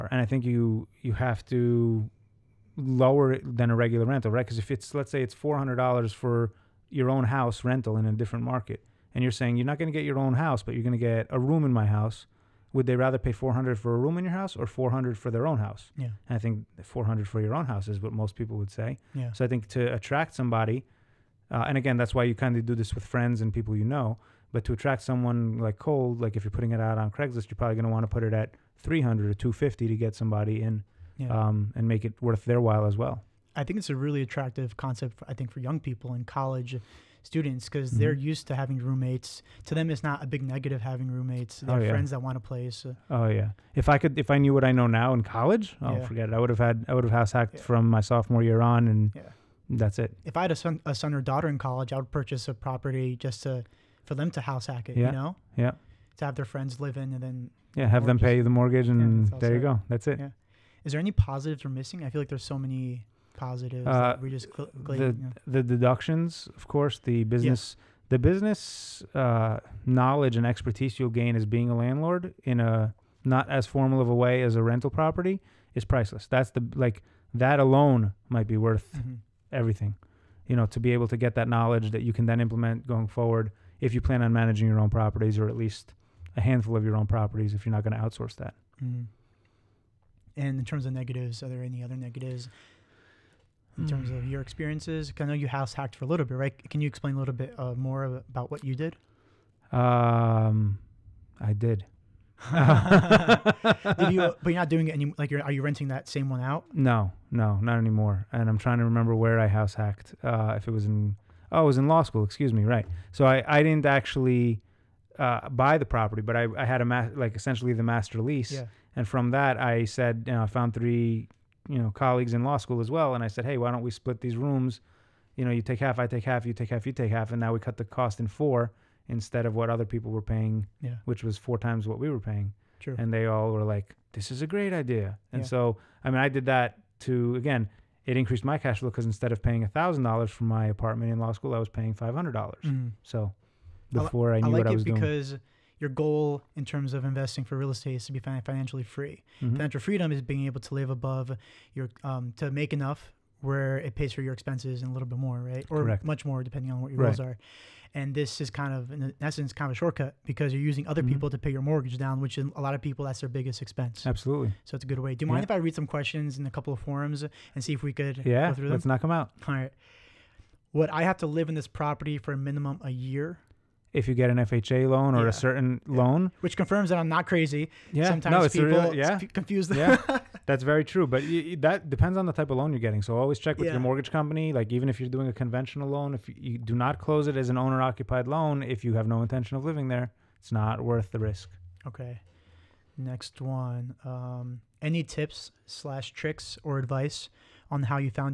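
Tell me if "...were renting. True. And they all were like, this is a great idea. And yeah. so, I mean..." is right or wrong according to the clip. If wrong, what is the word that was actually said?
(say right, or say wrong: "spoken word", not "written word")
wrong: "paying", not "renting".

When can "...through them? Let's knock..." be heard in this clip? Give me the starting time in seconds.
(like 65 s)
168 s.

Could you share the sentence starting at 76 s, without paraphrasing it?
That's the like that alone might be worth mm-hmm everything.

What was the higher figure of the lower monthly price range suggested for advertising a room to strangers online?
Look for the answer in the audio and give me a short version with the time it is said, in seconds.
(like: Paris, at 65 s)
300, at 28 s.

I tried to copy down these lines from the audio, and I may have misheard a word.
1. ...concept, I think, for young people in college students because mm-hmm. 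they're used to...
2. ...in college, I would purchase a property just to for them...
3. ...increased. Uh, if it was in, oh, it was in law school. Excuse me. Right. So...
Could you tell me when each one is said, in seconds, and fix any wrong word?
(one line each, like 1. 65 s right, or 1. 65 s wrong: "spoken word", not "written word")
1. 34 s right
2. 51 s right
3. 109 s wrong: "hacked", not "increased".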